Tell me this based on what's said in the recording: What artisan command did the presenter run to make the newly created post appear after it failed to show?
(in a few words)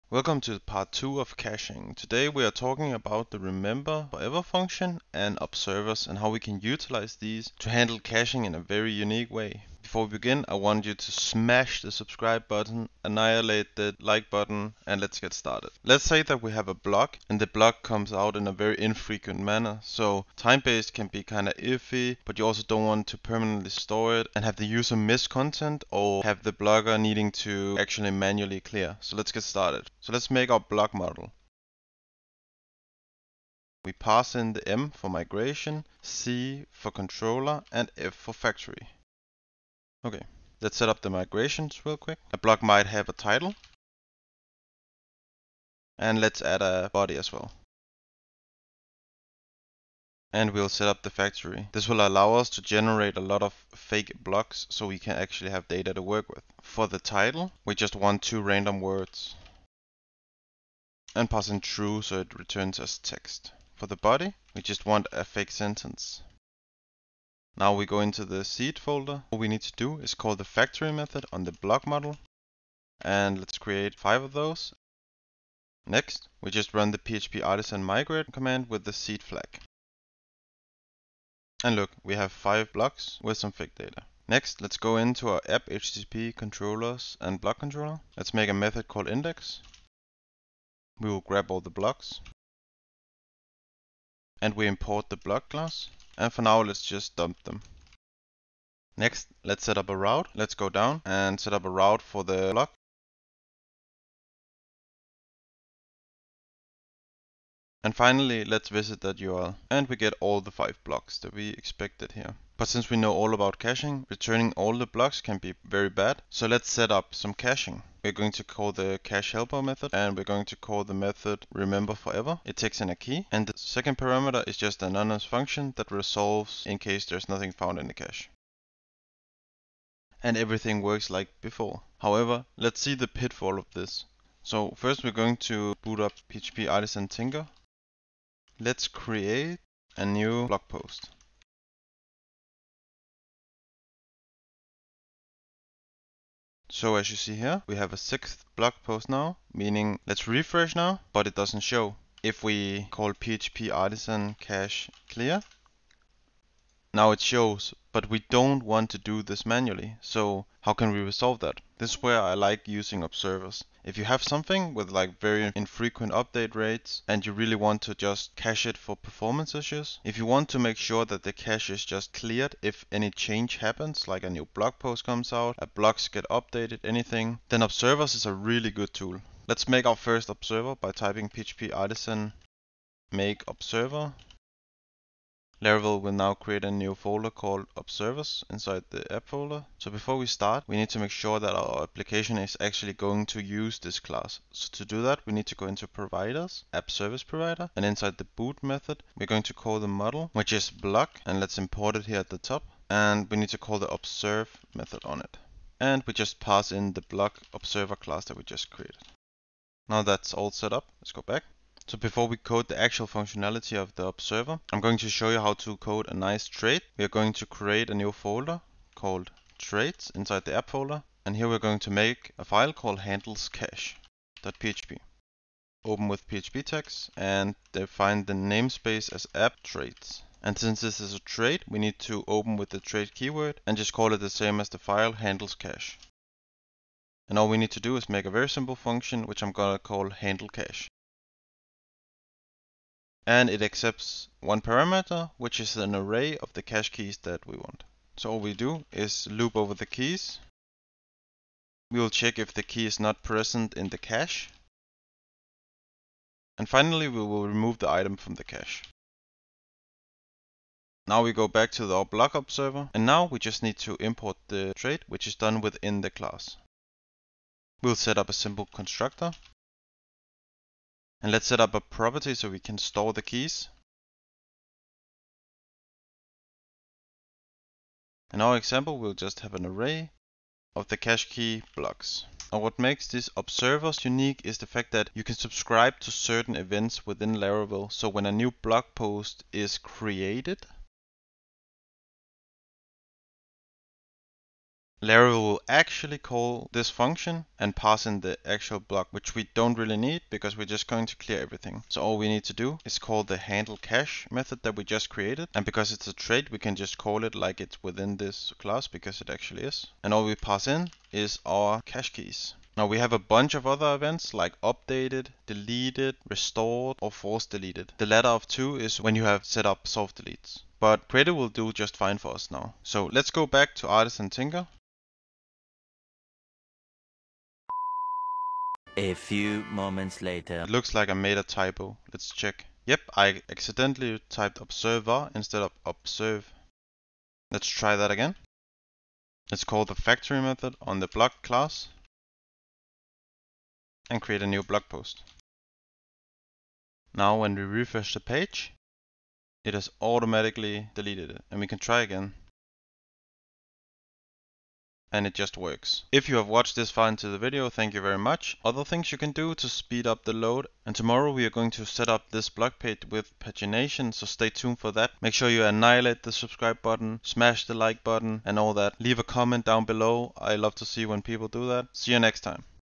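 php artisan cache clear.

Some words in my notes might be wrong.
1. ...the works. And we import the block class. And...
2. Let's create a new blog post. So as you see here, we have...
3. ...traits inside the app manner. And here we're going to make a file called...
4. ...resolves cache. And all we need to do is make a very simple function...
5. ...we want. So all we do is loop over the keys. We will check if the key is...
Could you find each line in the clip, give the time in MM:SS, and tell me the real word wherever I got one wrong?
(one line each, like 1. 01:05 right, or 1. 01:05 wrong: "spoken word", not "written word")
1. 01:31 wrong: "blocks", not "works"
2. 02:18 right
3. 03:39 wrong: "folder", not "manner"
4. 03:55 wrong: "handles", not "resolves"
5. 04:07 right.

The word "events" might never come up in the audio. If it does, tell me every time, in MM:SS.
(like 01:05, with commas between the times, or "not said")
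04:46, 05:13.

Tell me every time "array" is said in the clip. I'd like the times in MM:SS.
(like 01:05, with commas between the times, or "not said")
04:05, 04:39.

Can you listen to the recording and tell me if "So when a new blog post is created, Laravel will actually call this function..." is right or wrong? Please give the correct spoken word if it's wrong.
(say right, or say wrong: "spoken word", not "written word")
right.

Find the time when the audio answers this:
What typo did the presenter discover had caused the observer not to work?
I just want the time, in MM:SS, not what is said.
05:34.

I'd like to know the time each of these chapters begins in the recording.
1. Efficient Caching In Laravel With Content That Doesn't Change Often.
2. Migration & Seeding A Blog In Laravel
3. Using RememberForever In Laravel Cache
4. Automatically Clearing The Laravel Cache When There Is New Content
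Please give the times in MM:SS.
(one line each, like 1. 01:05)
1. 00:16
2. 00:29
3. 01:57
4. 02:55.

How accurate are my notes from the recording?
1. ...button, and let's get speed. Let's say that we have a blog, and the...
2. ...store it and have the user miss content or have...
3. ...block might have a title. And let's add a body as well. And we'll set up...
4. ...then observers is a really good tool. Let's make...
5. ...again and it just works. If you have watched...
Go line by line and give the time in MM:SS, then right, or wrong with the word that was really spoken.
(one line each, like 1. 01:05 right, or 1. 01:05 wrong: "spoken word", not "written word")
1. 00:14 wrong: "started", not "speed"
2. 00:23 right
3. 00:42 right
4. 02:57 right
5. 05:52 right.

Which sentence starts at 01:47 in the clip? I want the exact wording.
And finally, let's visit that URL.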